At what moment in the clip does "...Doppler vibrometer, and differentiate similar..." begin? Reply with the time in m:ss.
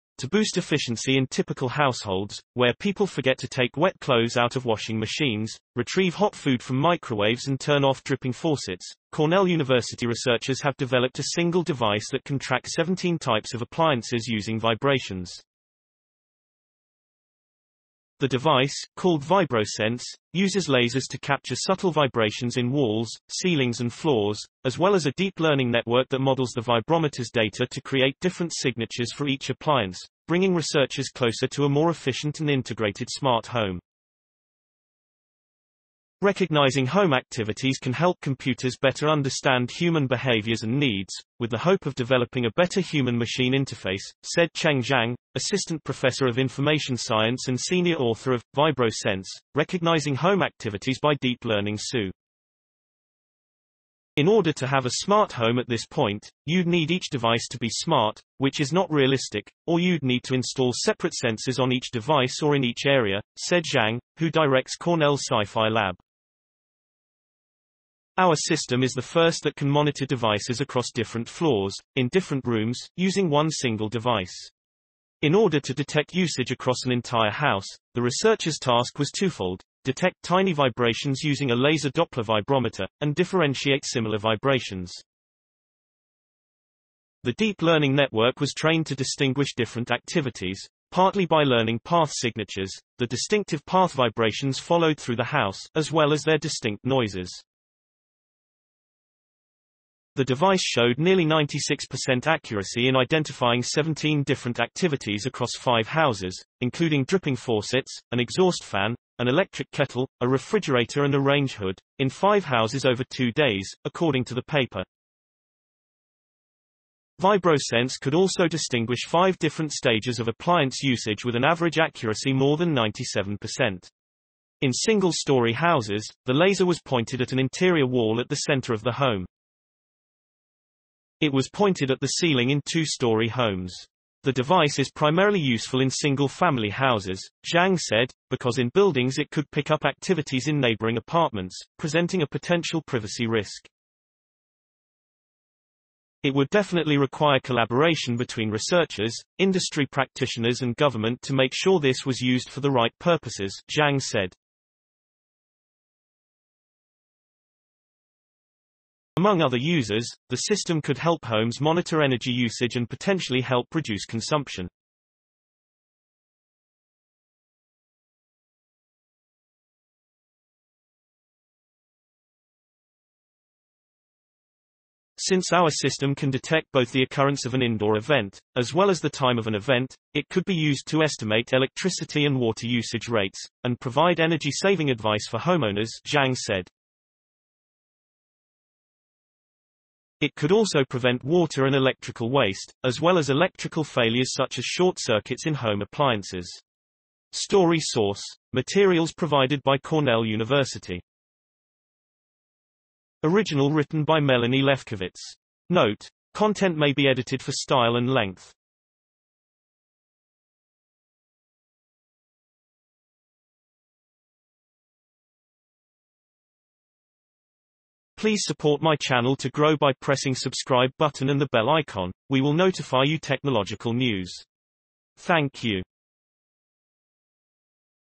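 1:21.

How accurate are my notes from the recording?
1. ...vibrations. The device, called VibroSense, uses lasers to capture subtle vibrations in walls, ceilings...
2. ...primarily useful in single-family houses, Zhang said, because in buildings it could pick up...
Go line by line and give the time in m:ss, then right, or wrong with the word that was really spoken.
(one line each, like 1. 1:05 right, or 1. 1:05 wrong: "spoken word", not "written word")
1. 0:14 right
2. 2:14 right.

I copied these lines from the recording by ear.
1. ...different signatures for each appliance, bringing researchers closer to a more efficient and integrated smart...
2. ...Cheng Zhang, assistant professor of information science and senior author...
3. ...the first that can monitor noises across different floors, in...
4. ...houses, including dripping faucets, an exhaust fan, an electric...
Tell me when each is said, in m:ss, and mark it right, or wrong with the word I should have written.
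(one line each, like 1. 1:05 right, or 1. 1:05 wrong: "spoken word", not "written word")
1. 0:28 right
2. 0:44 right
3. 1:08 wrong: "devices", not "noises"
4. 1:45 right.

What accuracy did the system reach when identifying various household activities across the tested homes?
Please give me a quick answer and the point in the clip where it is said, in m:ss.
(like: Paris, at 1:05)
96%, at 1:41.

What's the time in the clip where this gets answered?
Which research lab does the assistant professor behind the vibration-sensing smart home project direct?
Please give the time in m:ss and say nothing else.
1:04.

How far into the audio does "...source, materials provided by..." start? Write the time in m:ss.
3:17.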